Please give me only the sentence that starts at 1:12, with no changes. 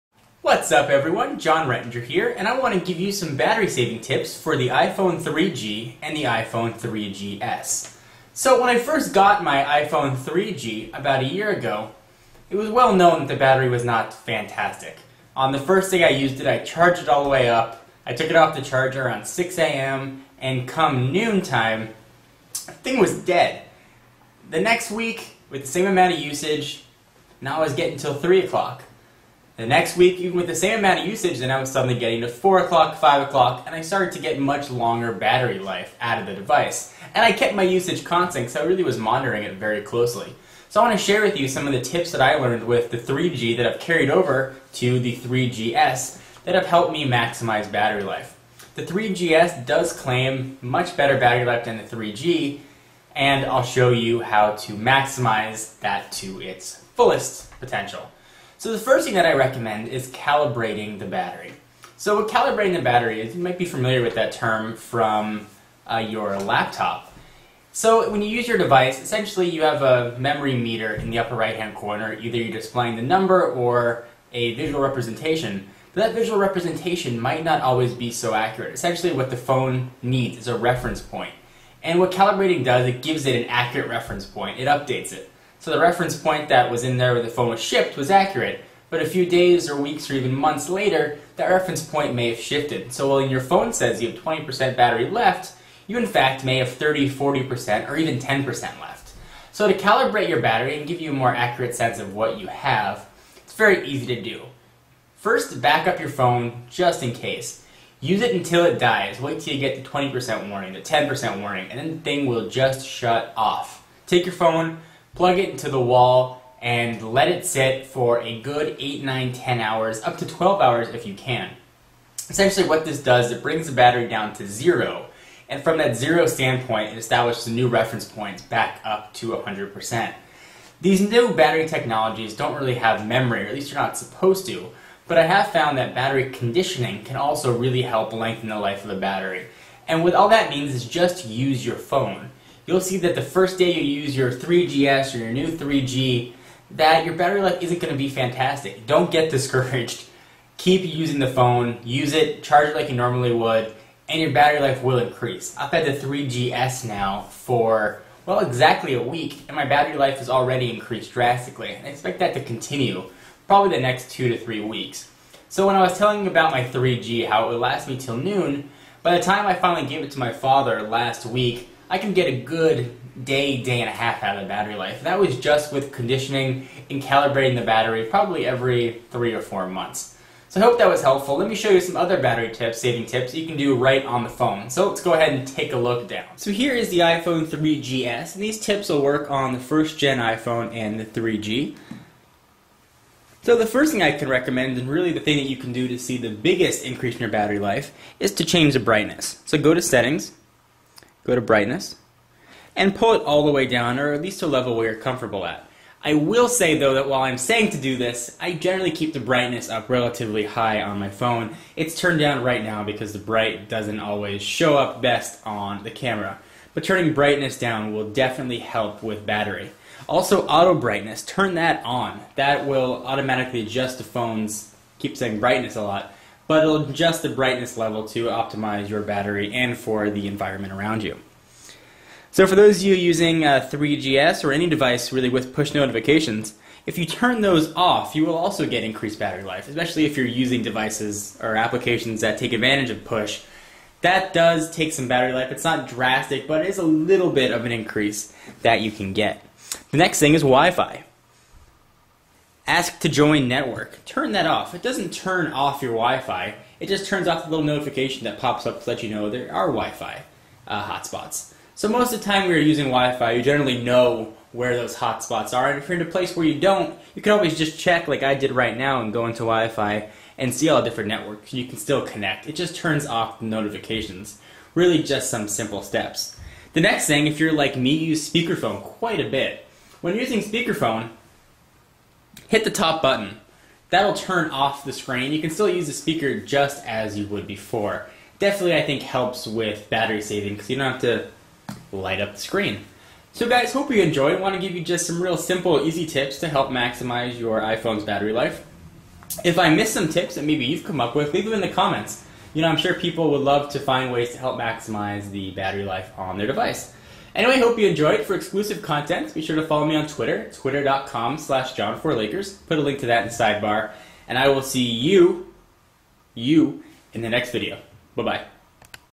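Either you're displaying the number or a visual representation.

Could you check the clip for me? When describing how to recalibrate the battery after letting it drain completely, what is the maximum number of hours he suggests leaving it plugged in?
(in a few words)
12 hours.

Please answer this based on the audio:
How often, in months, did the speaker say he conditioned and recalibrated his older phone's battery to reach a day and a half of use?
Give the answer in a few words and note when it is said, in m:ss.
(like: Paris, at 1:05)
every 3 or 4 months, at 2:58.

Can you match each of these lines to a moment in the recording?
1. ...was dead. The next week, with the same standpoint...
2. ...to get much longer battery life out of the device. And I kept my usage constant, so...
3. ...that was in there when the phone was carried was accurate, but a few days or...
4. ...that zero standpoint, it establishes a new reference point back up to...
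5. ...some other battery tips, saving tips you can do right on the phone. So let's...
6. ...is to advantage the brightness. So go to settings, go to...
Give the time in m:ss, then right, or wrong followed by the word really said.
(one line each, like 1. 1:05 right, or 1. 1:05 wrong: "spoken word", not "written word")
1. 0:22 wrong: "amount", not "standpoint"
2. 0:34 right
3. 1:26 wrong: "shipped", not "carried"
4. 2:05 right
5. 3:01 right
6. 3:18 wrong: "change", not "advantage".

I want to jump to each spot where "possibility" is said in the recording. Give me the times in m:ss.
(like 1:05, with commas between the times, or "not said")
not said.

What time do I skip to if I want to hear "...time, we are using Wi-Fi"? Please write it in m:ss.
4:22.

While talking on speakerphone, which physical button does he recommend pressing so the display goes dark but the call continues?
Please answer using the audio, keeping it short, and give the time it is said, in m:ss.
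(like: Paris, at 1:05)
the top button, at 4:42.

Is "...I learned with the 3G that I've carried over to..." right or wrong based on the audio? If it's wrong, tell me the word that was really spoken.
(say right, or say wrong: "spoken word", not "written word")
right.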